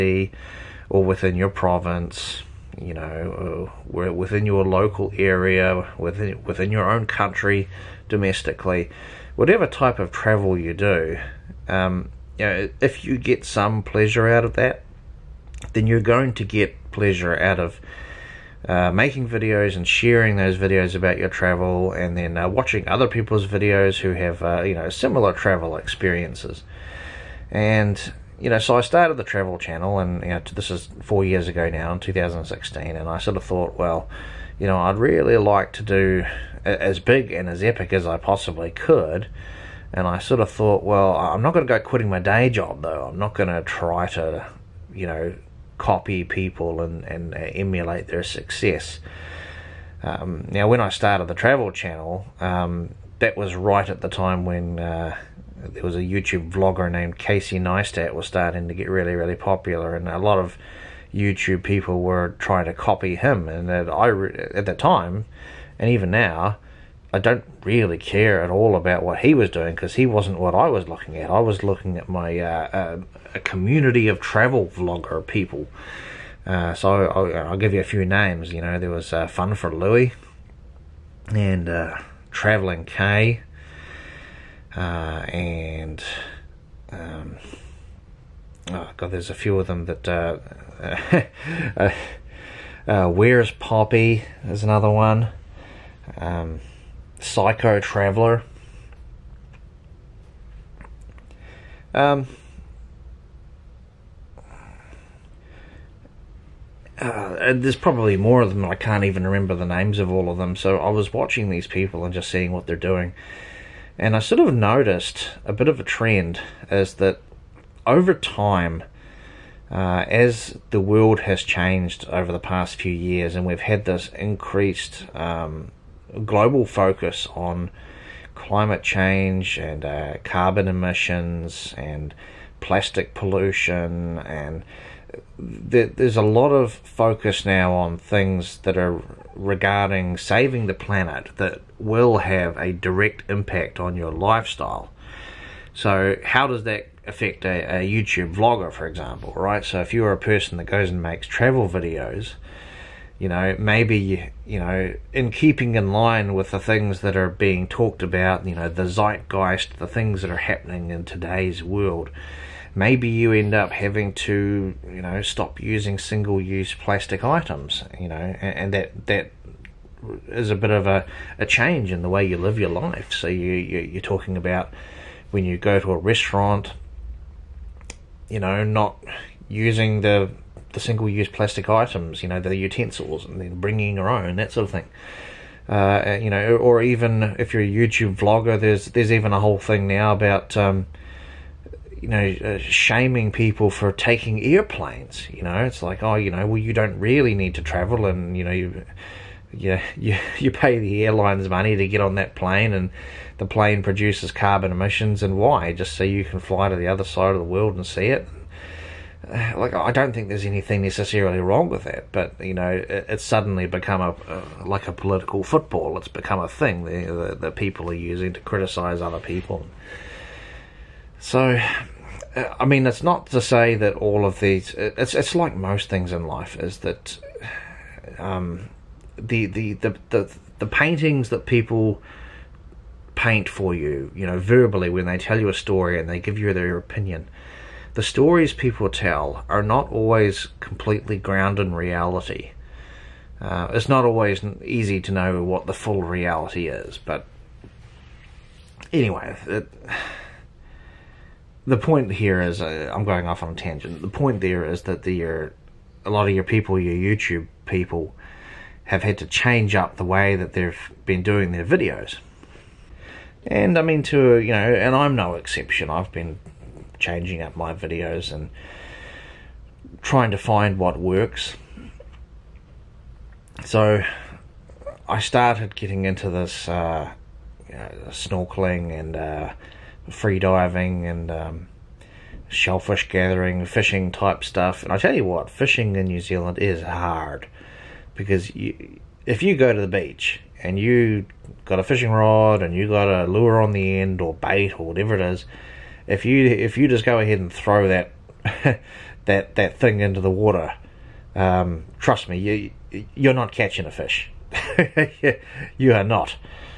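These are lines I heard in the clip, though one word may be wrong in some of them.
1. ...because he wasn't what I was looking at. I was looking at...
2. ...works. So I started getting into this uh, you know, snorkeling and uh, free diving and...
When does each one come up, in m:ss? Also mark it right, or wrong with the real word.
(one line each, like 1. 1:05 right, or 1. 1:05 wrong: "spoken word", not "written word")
1. 1:09 right
2. 4:30 right.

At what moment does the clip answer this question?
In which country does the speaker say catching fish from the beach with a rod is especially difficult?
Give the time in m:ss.
4:46.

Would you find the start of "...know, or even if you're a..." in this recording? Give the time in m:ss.
3:06.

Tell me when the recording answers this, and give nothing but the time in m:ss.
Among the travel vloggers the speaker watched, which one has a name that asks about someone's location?
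1:33.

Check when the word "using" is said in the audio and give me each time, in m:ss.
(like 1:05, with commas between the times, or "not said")
2:45, 2:59, 3:37.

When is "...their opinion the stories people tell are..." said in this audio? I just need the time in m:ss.
3:56.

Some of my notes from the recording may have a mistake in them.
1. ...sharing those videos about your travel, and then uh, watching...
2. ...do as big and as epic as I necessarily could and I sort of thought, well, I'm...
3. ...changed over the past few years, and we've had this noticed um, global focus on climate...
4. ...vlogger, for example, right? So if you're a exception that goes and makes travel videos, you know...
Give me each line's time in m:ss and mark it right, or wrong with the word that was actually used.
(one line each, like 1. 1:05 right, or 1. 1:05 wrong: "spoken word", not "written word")
1. 0:19 right
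2. 0:35 wrong: "possibly", not "necessarily"
3. 2:01 wrong: "increased", not "noticed"
4. 2:28 wrong: "person", not "exception".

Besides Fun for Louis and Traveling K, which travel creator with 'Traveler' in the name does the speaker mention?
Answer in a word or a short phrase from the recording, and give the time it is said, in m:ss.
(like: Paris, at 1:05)
Psycho Traveler, at 1:37.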